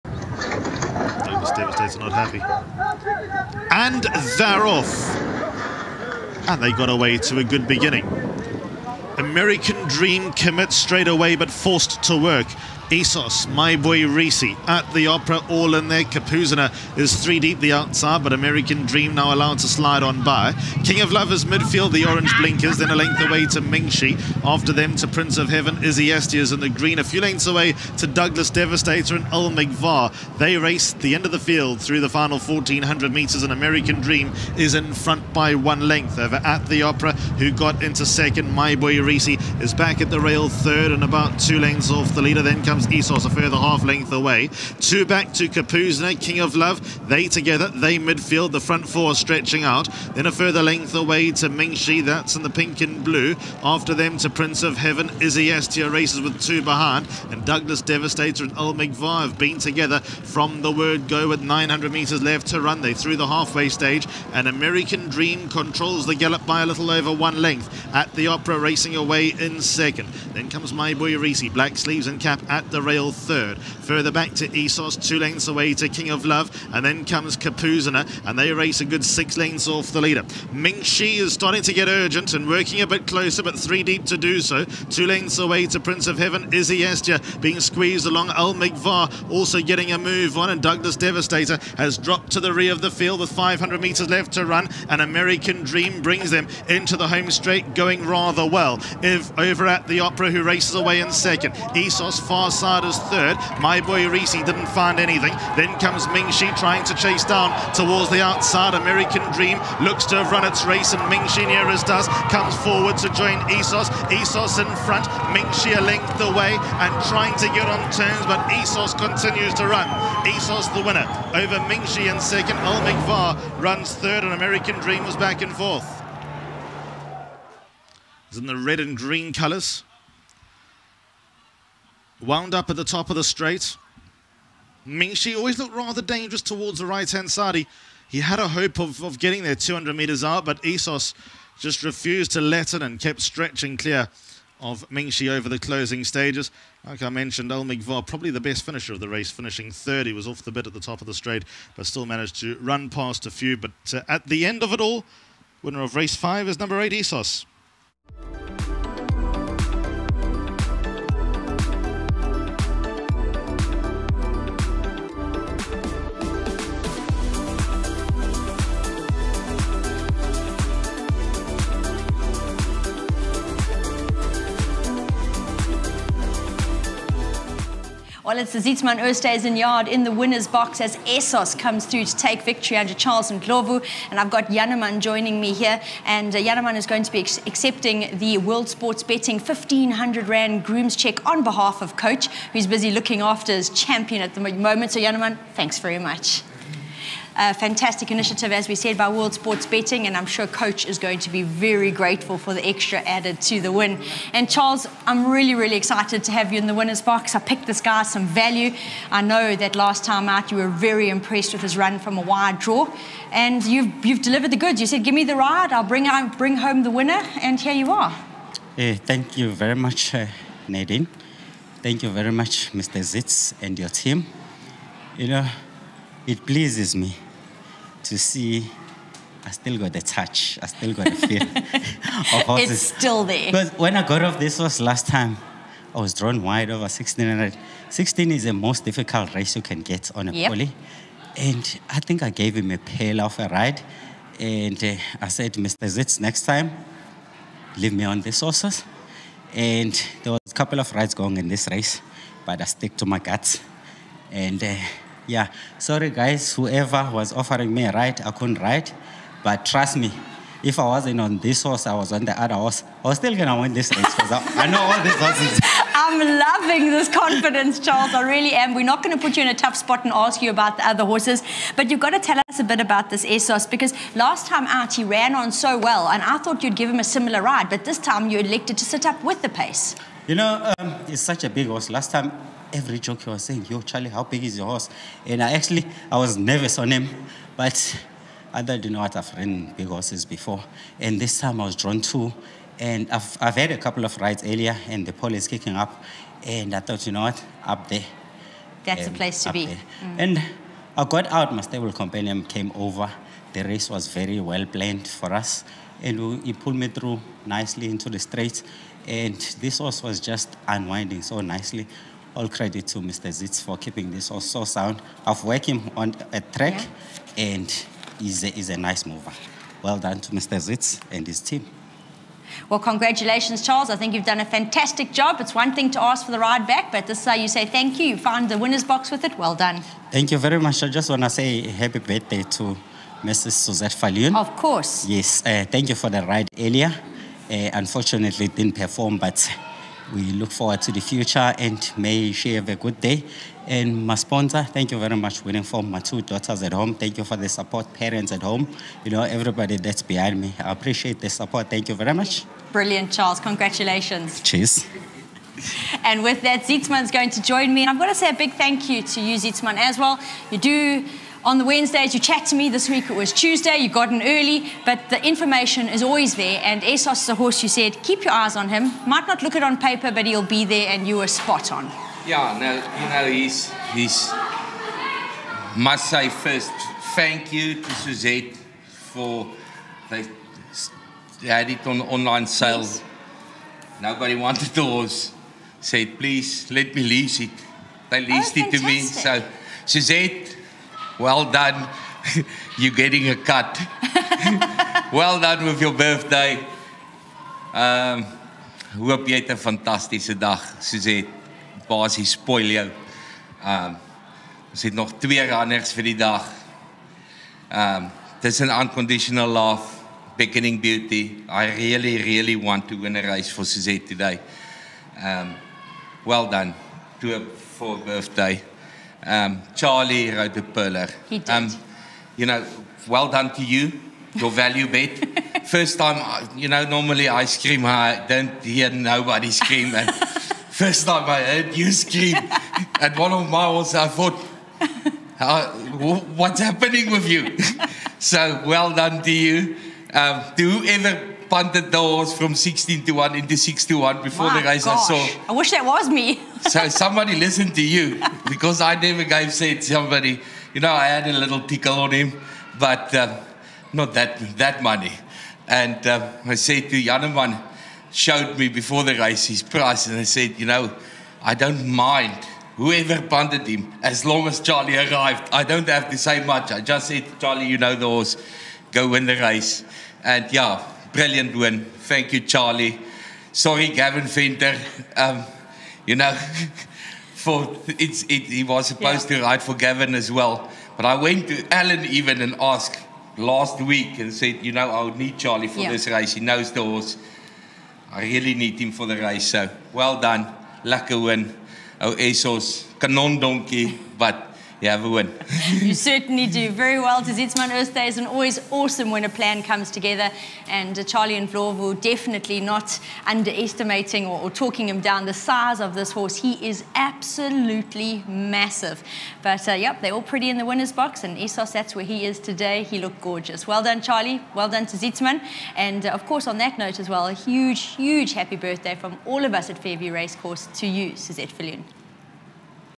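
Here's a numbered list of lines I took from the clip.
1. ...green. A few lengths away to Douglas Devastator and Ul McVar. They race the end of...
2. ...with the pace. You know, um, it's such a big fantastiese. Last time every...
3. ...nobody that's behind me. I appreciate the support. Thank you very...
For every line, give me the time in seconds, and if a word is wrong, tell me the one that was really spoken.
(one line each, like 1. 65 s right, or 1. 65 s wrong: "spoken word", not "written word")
1. 26 s right
2. 279 s wrong: "horse", not "fantastiese"
3. 349 s wrong: "everybody", not "nobody".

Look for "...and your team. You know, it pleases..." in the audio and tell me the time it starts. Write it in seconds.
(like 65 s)
223 s.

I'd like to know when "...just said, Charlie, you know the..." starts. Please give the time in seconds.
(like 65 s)
466 s.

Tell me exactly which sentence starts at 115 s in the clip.
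Mingxi a length away and trying to get on turns, but Essos continues to run.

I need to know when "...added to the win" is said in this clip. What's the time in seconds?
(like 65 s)
202 s.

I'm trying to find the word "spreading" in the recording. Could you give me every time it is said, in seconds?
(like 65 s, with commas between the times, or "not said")
not said.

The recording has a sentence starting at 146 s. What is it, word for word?
Like I mentioned, Elmig probably the best finisher of the race, finishing third.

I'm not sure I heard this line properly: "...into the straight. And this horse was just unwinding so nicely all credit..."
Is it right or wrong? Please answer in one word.
right.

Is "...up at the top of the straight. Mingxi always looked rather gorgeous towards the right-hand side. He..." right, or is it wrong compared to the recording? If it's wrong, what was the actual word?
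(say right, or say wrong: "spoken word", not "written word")
wrong: "dangerous", not "gorgeous".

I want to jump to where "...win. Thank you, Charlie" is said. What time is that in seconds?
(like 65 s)
471 s.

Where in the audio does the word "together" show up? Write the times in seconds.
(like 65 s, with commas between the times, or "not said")
47 s, 59 s, 499 s.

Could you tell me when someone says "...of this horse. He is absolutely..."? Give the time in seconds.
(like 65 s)
505 s.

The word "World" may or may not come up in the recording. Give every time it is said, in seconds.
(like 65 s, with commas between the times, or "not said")
188 s, 199 s.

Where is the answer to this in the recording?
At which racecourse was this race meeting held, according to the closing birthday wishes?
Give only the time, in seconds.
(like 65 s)
519 s.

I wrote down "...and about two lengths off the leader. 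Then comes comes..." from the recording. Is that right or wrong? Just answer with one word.
right.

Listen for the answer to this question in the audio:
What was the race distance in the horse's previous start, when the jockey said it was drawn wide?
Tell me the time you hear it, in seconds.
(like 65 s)
236 s.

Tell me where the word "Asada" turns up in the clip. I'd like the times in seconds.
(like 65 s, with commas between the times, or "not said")
102 s.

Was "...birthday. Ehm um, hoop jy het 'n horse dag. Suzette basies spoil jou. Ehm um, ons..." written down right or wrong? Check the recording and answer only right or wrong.
wrong.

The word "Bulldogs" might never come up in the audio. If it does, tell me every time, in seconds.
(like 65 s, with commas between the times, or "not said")
not said.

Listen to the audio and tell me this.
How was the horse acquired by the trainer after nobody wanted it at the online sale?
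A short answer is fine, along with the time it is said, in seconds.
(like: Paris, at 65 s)
Leased, at 388 s.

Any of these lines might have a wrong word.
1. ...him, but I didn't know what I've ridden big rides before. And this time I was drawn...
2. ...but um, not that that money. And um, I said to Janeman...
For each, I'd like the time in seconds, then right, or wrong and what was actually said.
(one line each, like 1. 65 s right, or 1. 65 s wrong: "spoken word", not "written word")
1. 286 s wrong: "horses", not "rides"
2. 452 s right.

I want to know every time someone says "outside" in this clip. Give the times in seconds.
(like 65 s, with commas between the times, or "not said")
17 s, 108 s.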